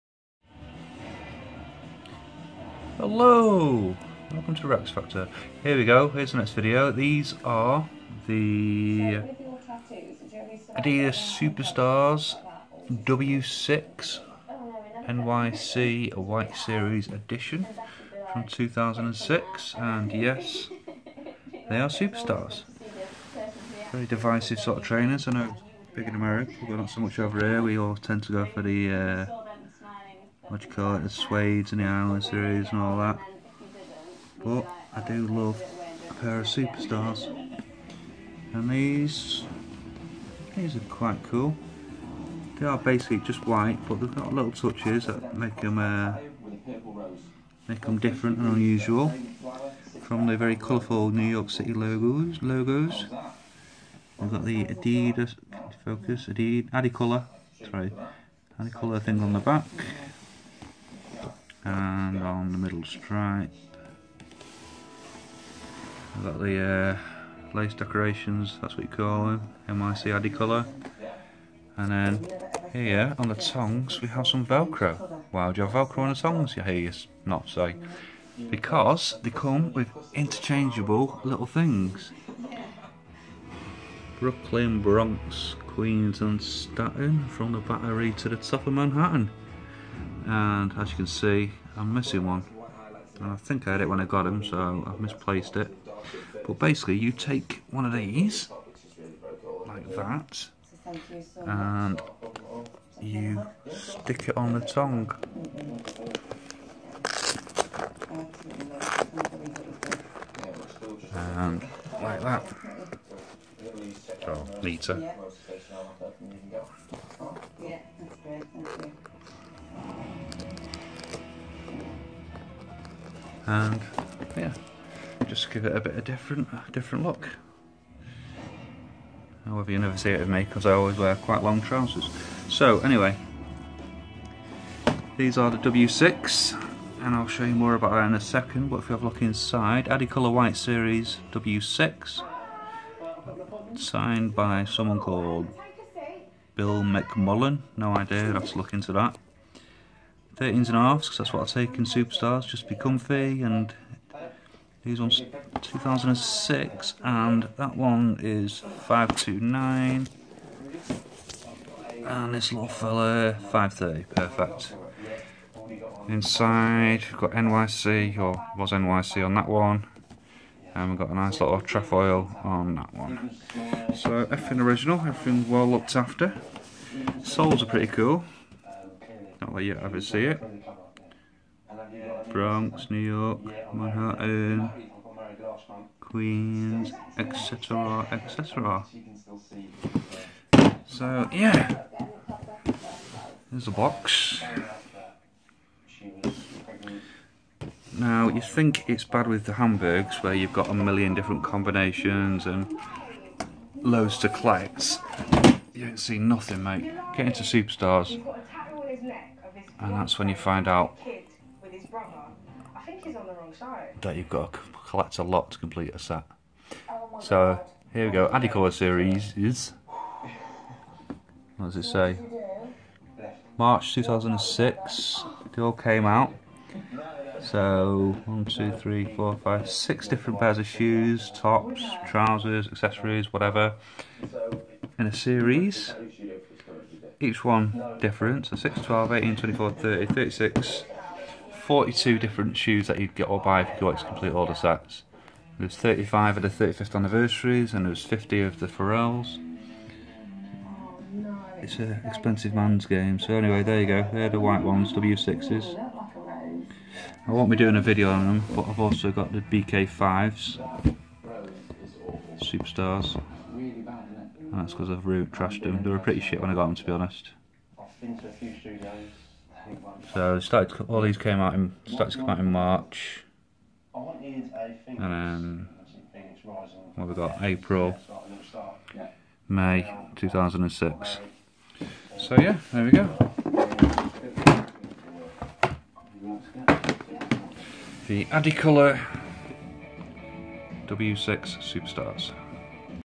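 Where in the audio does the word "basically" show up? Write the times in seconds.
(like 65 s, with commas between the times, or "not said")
42 s, 96 s.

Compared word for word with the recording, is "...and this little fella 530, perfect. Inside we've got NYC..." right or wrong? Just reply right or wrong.
right.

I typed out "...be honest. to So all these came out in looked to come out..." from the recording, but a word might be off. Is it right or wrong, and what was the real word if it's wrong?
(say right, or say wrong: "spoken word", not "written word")
wrong: "started", not "looked".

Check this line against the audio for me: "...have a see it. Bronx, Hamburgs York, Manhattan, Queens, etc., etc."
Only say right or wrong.
wrong.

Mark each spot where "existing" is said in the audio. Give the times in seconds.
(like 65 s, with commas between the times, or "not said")
not said.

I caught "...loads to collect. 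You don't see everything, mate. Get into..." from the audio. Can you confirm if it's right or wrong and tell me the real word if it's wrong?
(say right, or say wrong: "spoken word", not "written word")
wrong: "nothing", not "everything".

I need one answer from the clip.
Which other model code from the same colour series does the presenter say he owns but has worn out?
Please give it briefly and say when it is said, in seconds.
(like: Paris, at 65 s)
BK5, at 259 s.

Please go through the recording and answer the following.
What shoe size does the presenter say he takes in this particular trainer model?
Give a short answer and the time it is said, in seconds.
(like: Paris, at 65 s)
13 and a half, at 150 s.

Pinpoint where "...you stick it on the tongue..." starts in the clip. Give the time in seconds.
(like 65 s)
103 s.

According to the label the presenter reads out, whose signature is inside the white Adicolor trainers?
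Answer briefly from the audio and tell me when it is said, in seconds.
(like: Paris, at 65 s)
Bill McMullen, at 146 s.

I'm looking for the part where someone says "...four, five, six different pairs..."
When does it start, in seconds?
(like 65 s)
229 s.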